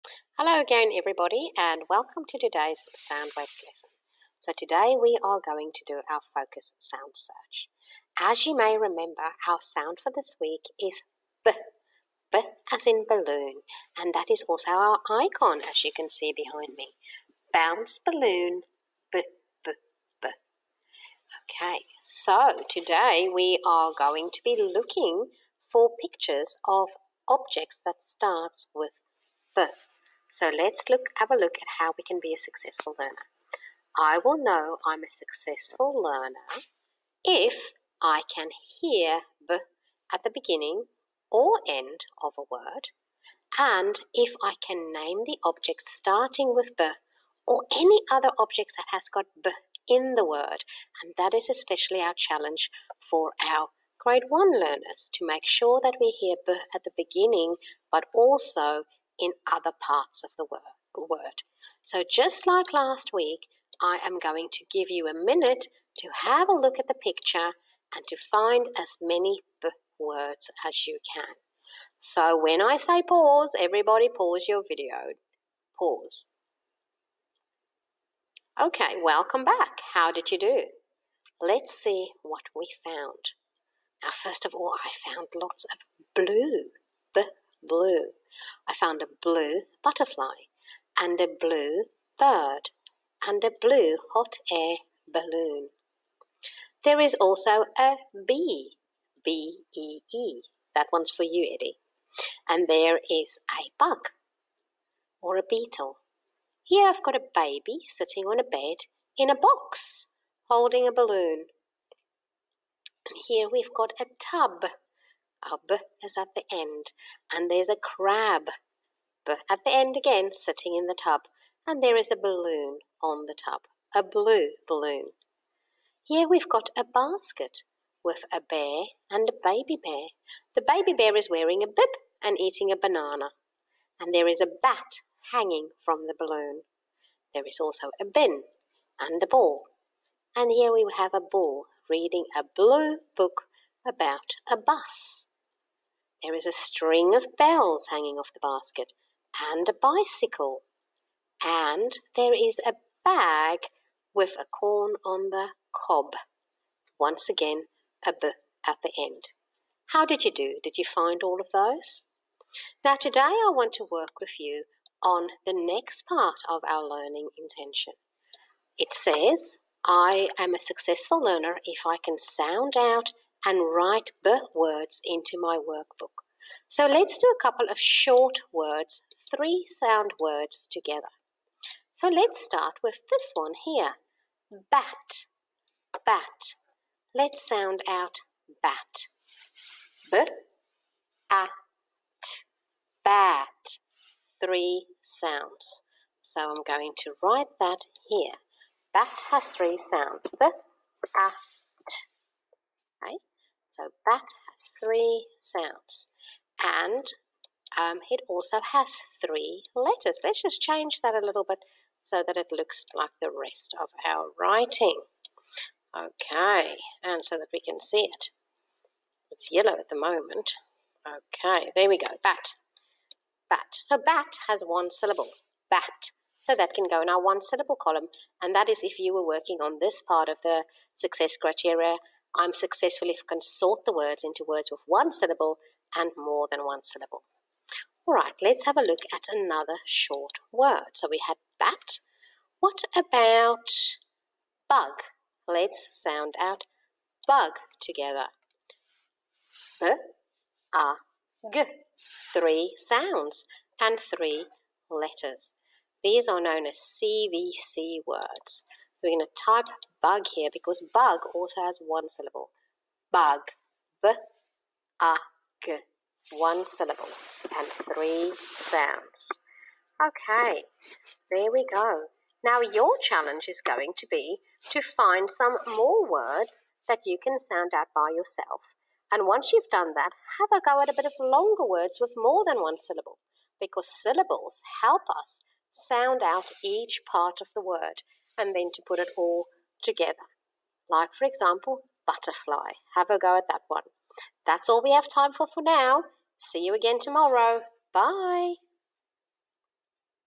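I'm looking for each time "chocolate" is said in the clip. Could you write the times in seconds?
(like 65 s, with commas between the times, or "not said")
not said.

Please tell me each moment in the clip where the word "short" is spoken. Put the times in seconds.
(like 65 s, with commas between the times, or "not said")
177 s, 239 s.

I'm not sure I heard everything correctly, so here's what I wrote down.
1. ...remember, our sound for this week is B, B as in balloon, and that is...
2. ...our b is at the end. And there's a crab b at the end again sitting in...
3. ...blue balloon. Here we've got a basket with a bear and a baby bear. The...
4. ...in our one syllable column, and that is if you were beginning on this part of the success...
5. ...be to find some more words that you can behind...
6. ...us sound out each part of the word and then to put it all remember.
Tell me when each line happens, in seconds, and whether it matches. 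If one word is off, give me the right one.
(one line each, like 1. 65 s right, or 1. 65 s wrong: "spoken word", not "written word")
1. 8 s right
2. 115 s right
3. 124 s right
4. 227 s wrong: "working", not "beginning"
5. 274 s wrong: "sound", not "behind"
6. 285 s wrong: "together", not "remember".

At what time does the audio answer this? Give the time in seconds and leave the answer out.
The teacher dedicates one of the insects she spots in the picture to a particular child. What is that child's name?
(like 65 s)
101 s.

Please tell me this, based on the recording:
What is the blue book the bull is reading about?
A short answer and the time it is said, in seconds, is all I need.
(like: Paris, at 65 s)
A bus, at 144 s.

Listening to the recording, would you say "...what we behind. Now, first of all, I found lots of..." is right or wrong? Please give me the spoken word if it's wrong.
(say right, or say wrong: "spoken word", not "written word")
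wrong: "found", not "behind".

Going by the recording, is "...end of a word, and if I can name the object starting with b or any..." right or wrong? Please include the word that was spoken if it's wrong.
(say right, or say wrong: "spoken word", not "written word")
right.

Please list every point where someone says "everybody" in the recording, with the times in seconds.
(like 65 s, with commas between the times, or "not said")
0 s, 73 s.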